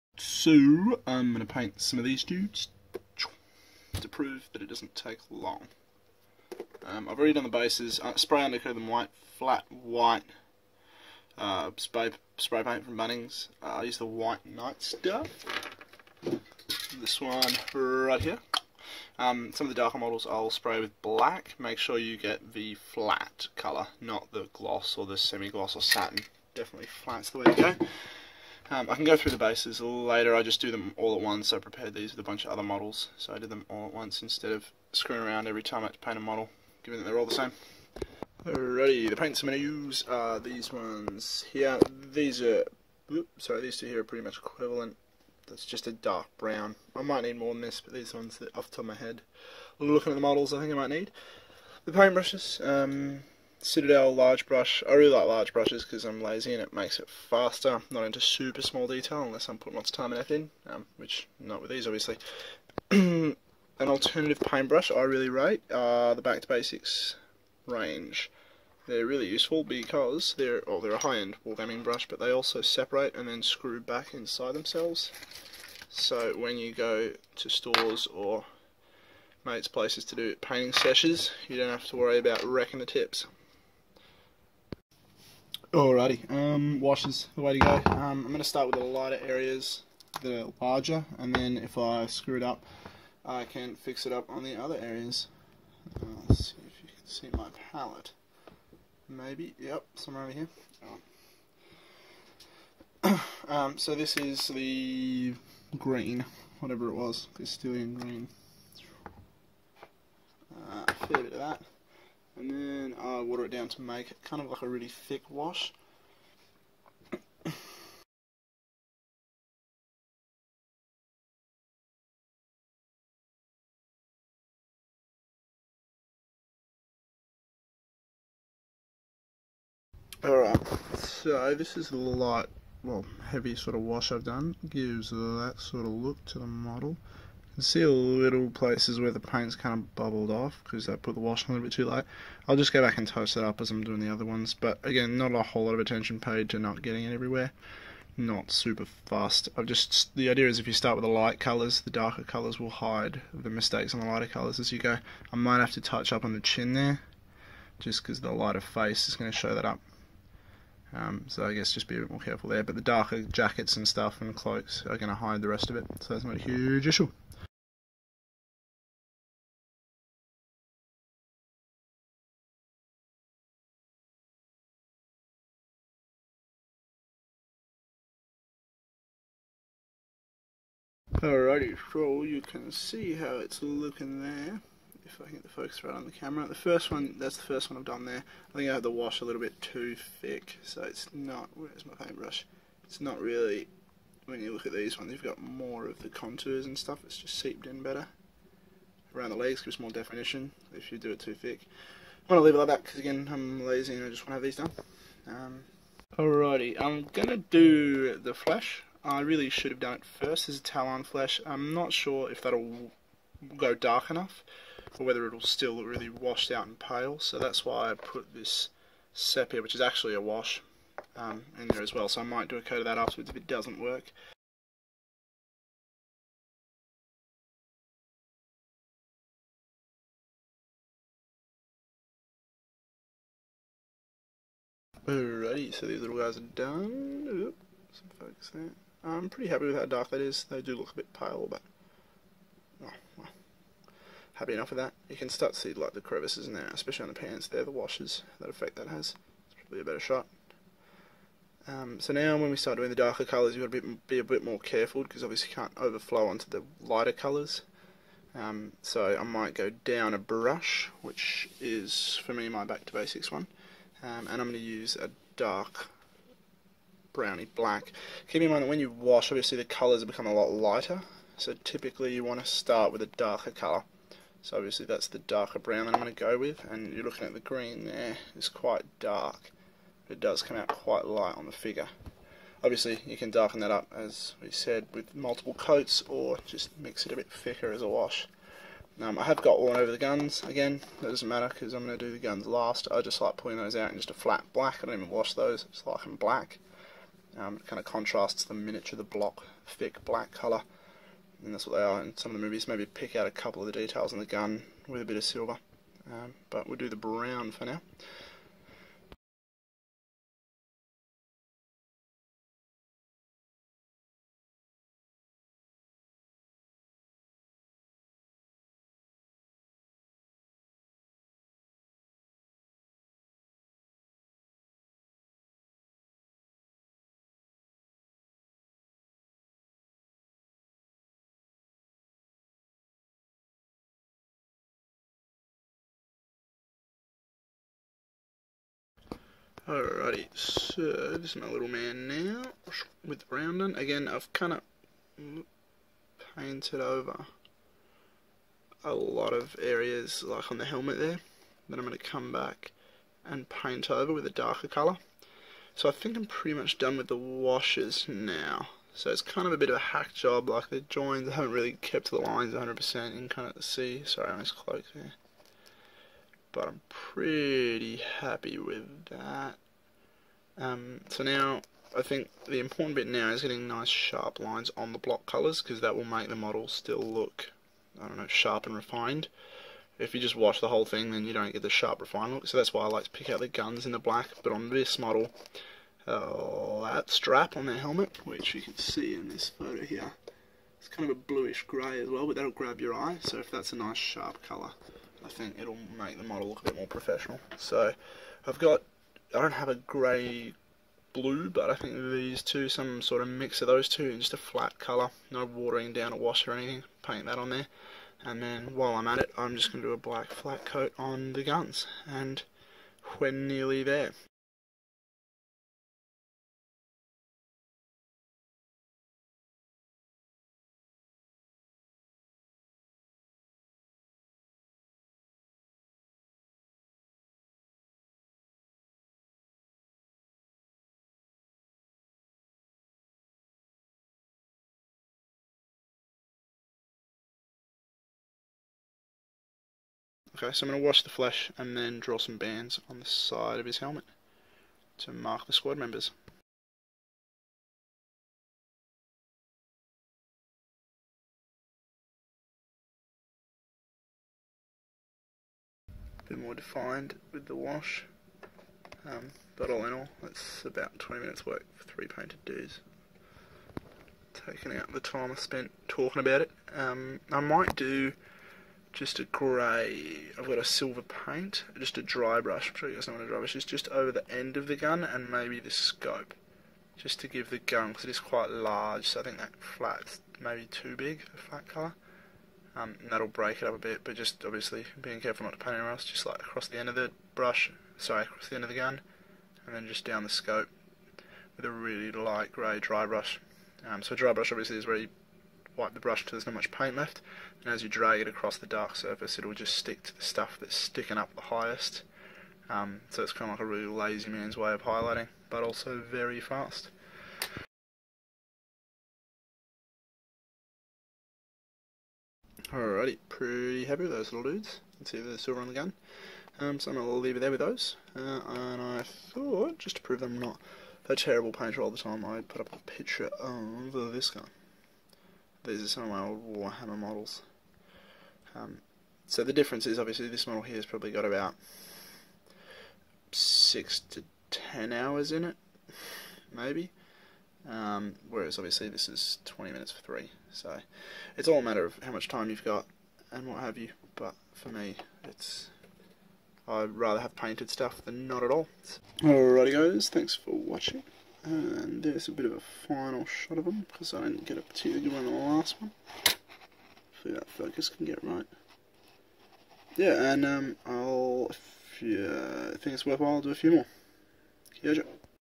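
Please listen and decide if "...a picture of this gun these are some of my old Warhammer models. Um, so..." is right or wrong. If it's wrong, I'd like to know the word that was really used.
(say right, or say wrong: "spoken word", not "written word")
right.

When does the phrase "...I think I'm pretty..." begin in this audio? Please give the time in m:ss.
5:55.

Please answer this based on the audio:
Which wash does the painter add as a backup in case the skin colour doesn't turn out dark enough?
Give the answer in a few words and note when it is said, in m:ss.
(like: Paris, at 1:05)
Sepia, at 3:39.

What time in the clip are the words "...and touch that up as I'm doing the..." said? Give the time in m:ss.
2:22.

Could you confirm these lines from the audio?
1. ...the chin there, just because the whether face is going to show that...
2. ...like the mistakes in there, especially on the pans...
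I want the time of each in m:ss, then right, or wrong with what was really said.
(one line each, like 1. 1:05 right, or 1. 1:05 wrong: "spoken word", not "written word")
1. 2:36 wrong: "lighter", not "whether"
2. 4:05 wrong: "crevices", not "mistakes".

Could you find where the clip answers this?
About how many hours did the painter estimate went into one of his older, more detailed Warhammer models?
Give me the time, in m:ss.
8:53.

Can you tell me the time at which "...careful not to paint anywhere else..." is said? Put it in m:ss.
8:05.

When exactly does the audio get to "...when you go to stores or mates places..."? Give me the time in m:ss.
1:16.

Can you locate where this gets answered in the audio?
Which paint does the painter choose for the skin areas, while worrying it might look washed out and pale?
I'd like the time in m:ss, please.
3:30.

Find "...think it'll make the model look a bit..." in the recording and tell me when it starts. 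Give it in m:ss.
6:35.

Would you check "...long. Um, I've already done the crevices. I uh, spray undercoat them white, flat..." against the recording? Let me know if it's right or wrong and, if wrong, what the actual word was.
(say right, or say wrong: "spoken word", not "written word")
wrong: "bases", not "crevices".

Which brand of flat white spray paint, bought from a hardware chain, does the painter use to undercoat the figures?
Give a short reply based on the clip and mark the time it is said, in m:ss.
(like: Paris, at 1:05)
White Knight, at 0:14.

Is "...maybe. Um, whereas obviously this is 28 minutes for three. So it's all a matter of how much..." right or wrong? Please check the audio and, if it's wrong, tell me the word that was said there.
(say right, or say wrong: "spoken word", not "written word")
wrong: "20", not "28".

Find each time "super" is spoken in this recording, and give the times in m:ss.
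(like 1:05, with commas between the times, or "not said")
0:58, 2:28.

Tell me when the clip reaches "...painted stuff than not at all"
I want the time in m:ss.
9:07.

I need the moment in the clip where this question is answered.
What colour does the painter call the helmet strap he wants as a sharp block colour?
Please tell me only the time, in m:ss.
6:31.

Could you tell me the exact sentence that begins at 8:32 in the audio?
Alrighty, pretty happy with those little dudes.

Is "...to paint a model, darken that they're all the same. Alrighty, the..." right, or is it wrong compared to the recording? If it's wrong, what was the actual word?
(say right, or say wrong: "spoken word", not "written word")
wrong: "given", not "darken".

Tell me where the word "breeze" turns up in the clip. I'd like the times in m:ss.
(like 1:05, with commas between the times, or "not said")
not said.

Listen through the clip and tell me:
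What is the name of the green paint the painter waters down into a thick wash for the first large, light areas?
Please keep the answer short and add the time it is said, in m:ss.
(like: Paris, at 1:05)
Castellan Green, at 1:47.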